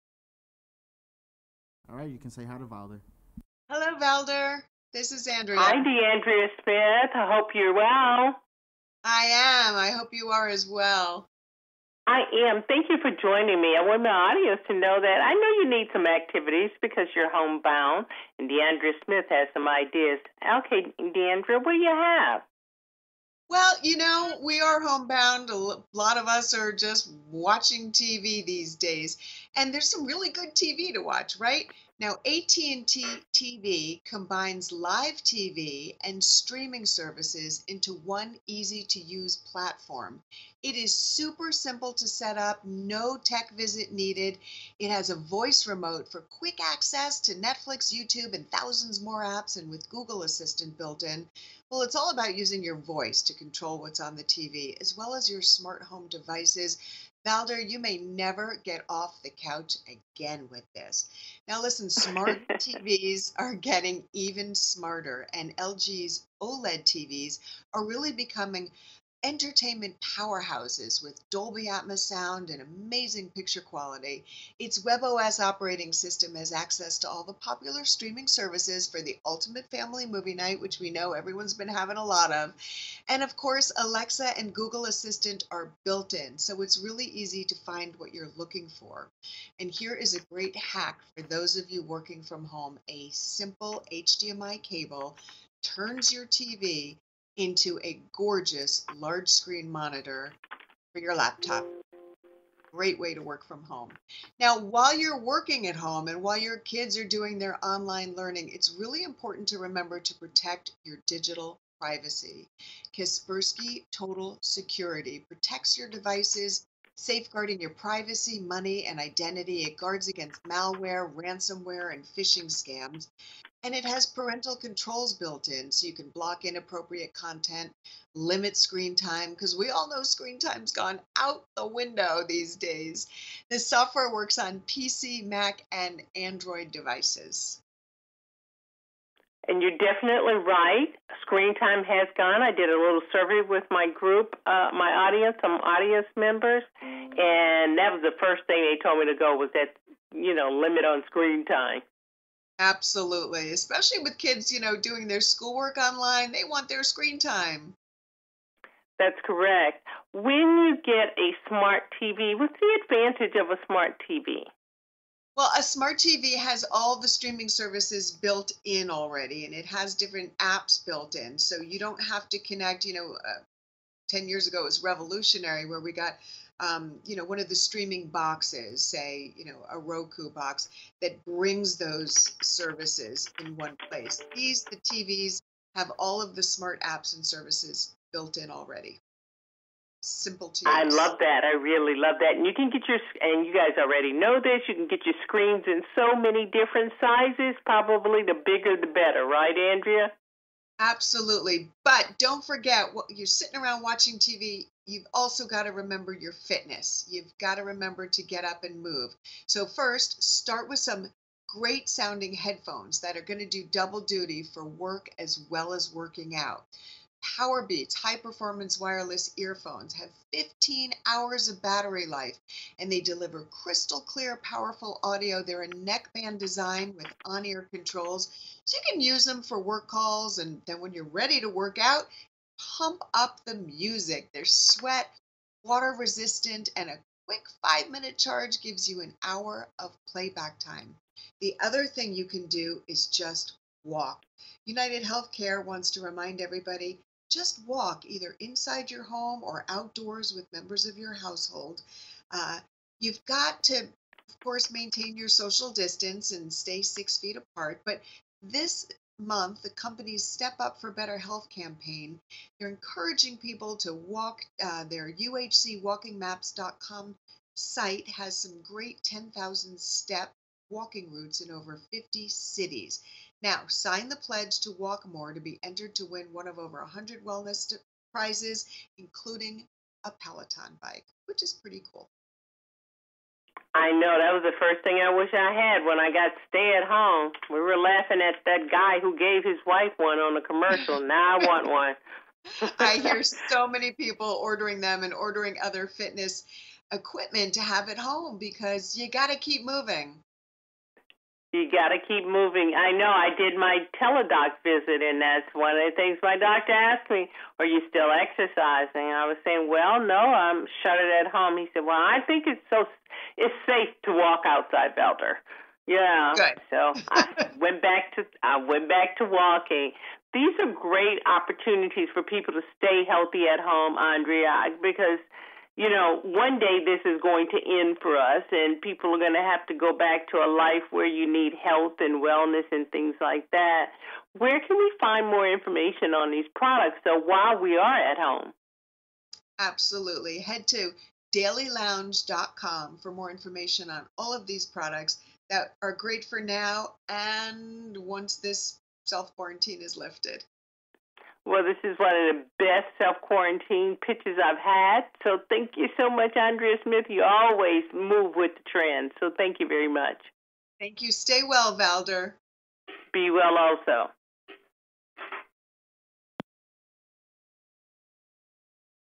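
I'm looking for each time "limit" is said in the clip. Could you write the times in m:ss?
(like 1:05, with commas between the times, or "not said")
2:08, 2:30.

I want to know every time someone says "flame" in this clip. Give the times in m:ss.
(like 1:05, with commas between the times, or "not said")
not said.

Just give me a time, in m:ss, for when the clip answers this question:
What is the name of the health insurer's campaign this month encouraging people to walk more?
4:20.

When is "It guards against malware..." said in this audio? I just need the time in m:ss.
1:59.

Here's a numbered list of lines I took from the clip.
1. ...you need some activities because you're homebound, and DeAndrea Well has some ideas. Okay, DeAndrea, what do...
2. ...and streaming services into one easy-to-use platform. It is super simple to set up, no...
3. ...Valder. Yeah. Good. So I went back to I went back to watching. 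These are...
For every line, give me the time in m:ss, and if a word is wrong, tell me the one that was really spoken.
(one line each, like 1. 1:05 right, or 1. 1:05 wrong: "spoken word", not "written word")
1. 0:15 wrong: "Smith", not "Well"
2. 0:36 right
3. 5:14 wrong: "walking", not "watching".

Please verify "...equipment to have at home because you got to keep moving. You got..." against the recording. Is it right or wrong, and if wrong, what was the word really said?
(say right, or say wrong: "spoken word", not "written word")
right.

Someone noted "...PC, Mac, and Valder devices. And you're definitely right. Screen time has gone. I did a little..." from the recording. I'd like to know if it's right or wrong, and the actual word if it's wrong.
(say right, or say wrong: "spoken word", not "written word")
wrong: "Android", not "Valder".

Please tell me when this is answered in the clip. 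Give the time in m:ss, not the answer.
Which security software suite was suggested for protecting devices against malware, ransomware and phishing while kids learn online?
1:52.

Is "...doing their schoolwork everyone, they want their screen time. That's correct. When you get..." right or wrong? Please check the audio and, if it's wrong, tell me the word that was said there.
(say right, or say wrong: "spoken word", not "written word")
wrong: "online", not "everyone".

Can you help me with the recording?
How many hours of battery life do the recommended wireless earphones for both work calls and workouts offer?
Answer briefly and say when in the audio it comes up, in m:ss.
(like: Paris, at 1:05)
15 hours, at 3:40.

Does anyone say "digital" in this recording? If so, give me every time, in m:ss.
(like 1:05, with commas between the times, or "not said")
1:51.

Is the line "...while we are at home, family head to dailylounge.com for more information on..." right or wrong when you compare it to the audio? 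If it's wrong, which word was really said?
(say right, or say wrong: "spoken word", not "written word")
wrong: "absolutely", not "family".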